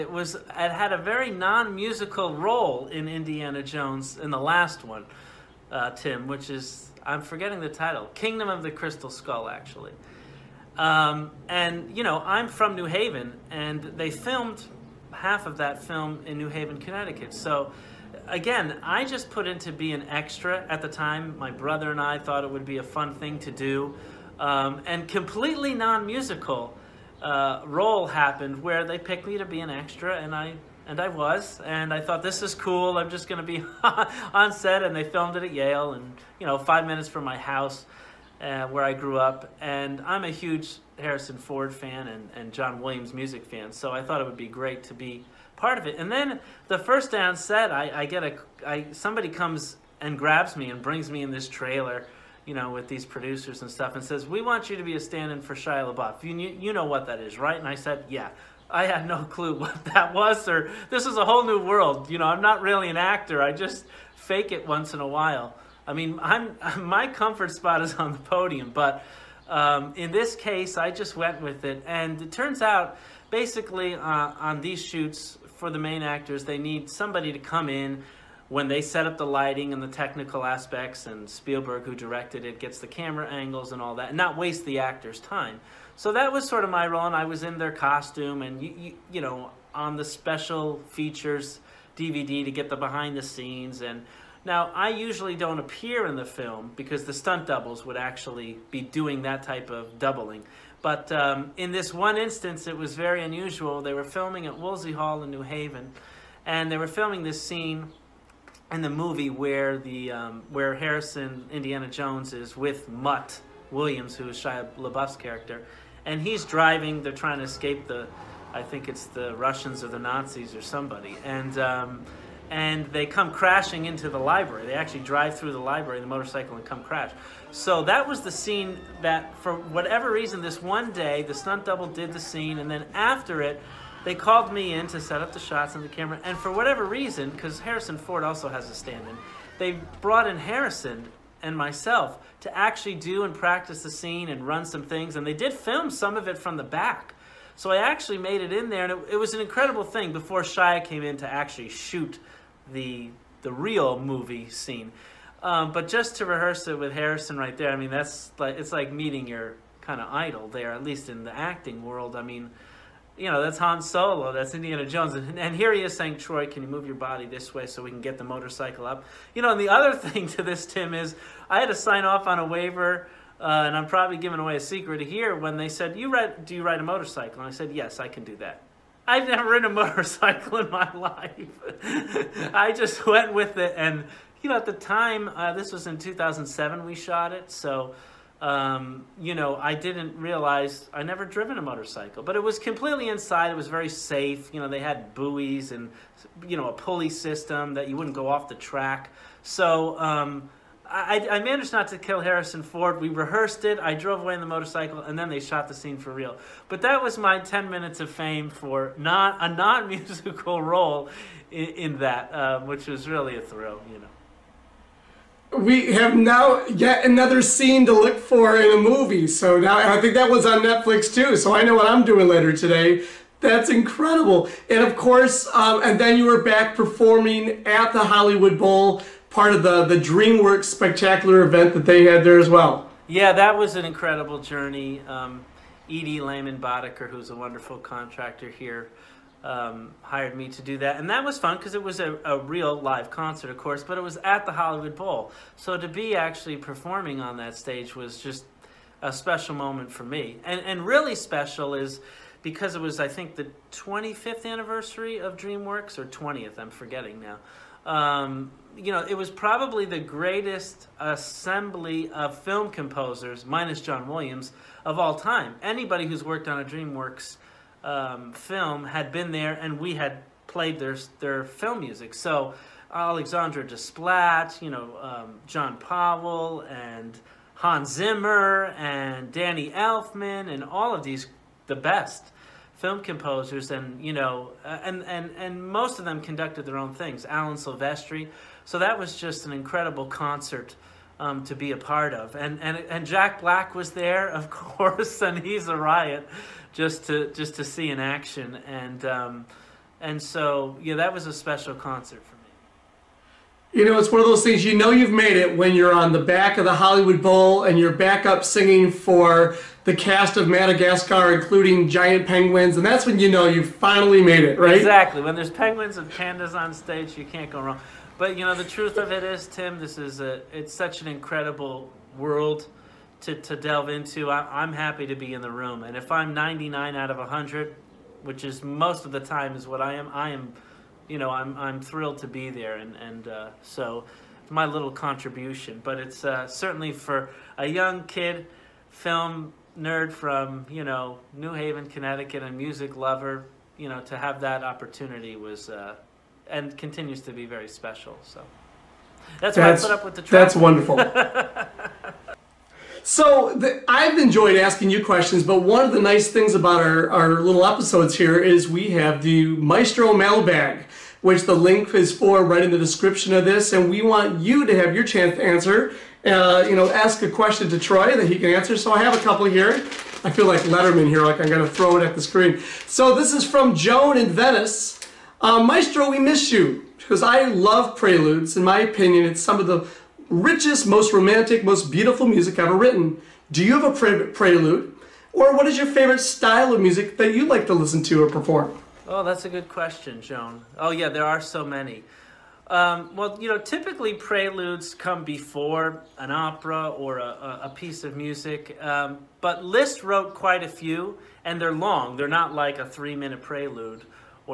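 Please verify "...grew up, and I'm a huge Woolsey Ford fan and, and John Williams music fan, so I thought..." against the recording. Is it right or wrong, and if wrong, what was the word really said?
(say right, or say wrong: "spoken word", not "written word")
wrong: "Harrison", not "Woolsey".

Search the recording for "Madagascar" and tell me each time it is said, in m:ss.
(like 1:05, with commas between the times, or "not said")
5:10.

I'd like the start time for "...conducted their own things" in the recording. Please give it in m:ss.
4:46.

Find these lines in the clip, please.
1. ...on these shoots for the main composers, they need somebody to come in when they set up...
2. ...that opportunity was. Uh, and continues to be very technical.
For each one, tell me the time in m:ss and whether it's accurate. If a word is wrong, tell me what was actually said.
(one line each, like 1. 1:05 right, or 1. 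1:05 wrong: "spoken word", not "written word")
1. 1:14 wrong: "actors", not "composers"
2. 5:44 wrong: "special", not "technical".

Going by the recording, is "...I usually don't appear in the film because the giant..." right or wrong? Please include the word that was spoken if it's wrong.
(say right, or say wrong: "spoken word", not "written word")
wrong: "stunt", not "giant".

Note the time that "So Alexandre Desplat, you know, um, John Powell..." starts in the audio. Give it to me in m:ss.
4:32.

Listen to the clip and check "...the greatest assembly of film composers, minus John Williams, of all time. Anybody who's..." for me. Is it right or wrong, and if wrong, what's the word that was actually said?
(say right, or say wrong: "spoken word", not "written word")
right.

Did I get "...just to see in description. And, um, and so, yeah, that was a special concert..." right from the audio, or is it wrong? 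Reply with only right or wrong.
wrong.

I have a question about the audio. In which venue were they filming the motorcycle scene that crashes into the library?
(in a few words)
Woolsey Hall.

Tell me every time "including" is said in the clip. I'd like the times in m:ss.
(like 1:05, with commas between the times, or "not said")
5:11.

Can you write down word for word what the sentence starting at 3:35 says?
We have now yet another scene to look for in a movie.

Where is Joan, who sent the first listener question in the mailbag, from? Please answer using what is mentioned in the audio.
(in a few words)
Venice.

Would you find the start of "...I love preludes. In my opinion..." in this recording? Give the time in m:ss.
6:17.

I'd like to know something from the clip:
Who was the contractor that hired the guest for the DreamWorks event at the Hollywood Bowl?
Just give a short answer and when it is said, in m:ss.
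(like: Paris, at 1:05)
Edie Lehman Boddicker, at 3:55.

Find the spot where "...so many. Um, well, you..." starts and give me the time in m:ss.
6:31.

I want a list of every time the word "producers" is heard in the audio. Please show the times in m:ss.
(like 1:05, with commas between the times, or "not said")
0:53.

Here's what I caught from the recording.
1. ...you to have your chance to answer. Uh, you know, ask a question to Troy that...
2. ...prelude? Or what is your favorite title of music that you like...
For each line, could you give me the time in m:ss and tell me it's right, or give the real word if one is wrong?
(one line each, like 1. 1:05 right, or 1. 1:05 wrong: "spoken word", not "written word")
1. 6:04 right
2. 6:24 wrong: "style", not "title".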